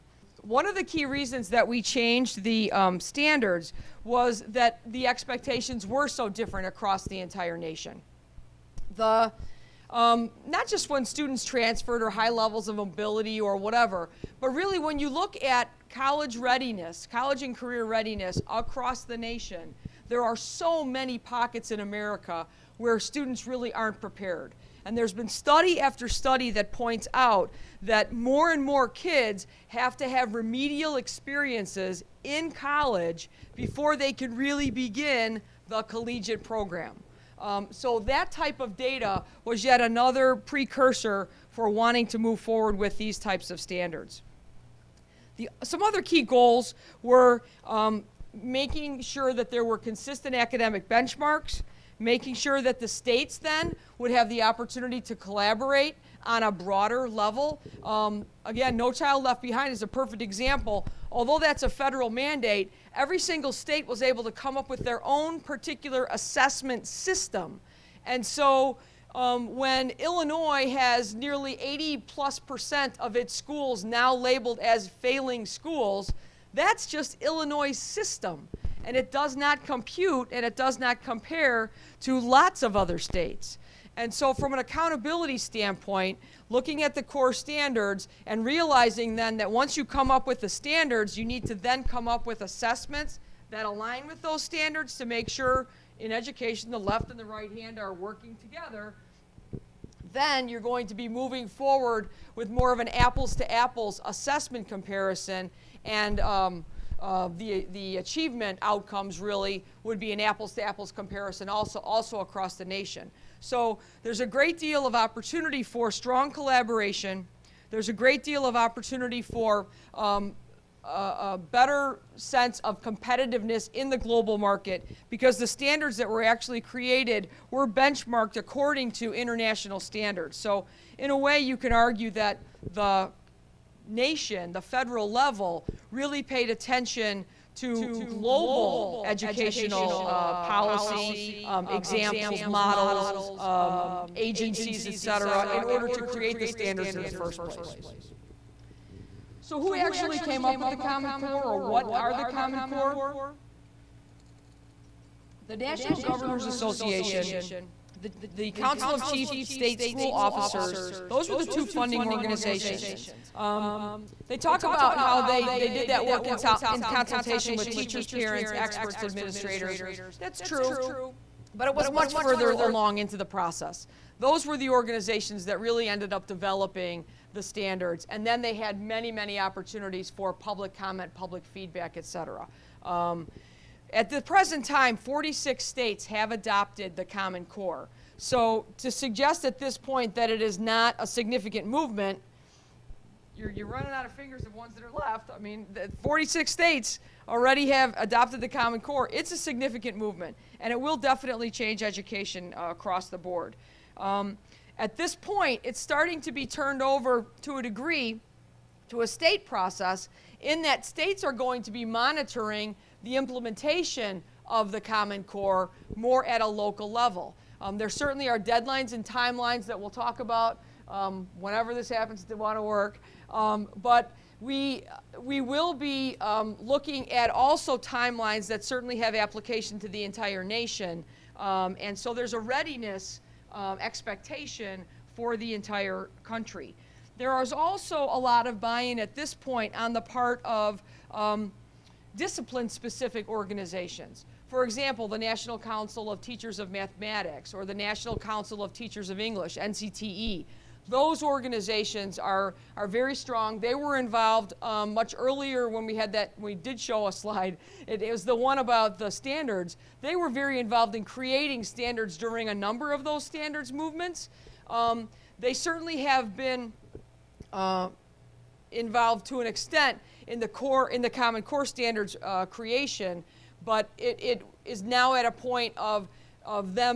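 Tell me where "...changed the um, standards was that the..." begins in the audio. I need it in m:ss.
0:01.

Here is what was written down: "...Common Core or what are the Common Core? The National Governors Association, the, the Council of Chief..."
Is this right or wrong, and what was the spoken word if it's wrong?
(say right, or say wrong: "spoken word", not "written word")
right.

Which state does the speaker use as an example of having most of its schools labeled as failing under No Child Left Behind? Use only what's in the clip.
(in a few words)
Illinois.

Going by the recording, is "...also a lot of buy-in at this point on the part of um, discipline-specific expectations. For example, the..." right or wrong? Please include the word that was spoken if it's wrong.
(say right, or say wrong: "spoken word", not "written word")
wrong: "organizations", not "expectations".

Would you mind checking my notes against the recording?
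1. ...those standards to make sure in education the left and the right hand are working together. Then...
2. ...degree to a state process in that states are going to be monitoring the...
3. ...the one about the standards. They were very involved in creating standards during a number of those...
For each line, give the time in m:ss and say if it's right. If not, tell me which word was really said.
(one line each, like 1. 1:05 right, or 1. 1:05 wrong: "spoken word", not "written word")
1. 1:34 right
2. 3:27 right
3. 4:18 right.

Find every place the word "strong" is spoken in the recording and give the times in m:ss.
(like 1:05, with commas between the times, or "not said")
1:55, 4:13.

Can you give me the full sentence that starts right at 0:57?
Um, again, No Child Left Behind is a perfect example.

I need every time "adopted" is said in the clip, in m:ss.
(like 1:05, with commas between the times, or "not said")
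3:06, 3:17.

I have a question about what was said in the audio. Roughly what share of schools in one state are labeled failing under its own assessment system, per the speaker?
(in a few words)
80 plus percent.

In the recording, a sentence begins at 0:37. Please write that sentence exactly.
Um, so that type of data was yet another precursor for wanting to move forward with these types of standards.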